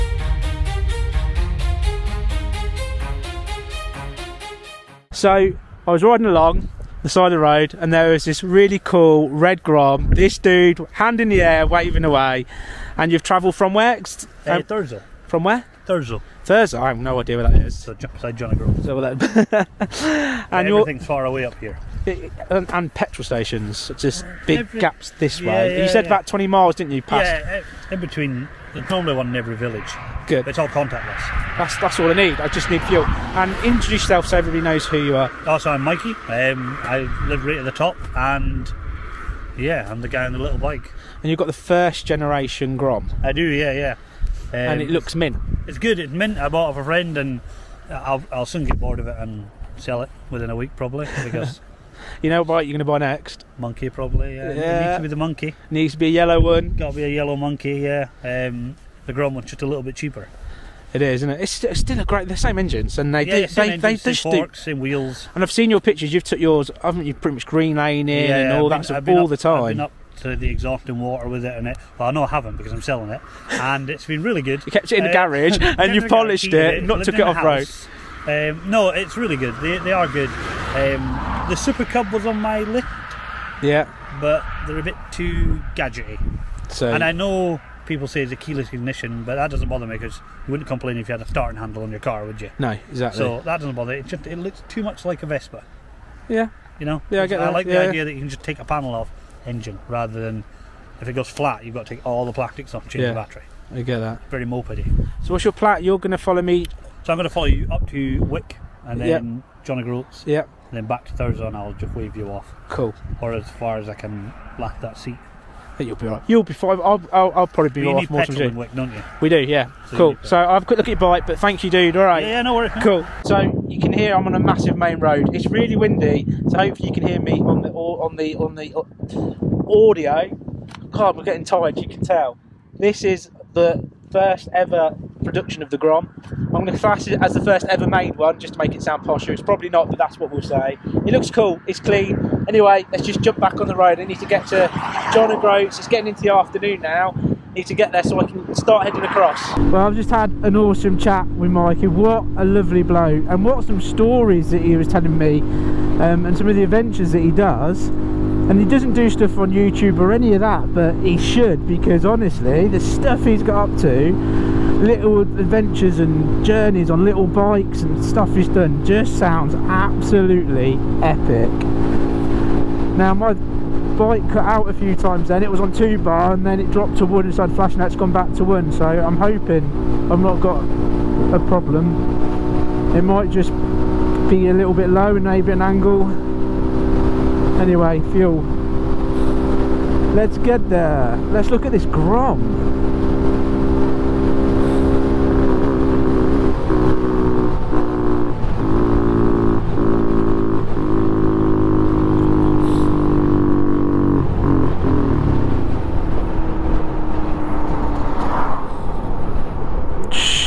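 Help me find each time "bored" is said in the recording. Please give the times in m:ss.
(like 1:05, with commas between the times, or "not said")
0:48.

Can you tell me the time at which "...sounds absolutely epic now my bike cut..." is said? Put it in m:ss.
2:49.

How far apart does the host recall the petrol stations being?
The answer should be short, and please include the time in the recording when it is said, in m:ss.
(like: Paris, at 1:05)
20 miles, at 0:26.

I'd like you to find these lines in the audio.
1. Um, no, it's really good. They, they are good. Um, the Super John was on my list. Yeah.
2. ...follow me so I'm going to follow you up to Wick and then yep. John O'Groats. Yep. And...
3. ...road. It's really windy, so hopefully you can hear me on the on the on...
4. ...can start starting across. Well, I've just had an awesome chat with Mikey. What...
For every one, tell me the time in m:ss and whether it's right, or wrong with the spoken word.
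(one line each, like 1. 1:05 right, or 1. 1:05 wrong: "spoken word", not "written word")
1. 1:18 wrong: "Cub", not "John"
2. 1:46 right
3. 2:04 right
4. 2:28 wrong: "heading", not "starting".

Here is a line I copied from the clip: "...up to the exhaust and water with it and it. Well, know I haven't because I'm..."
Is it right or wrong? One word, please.
right.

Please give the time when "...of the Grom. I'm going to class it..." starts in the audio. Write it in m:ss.
2:15.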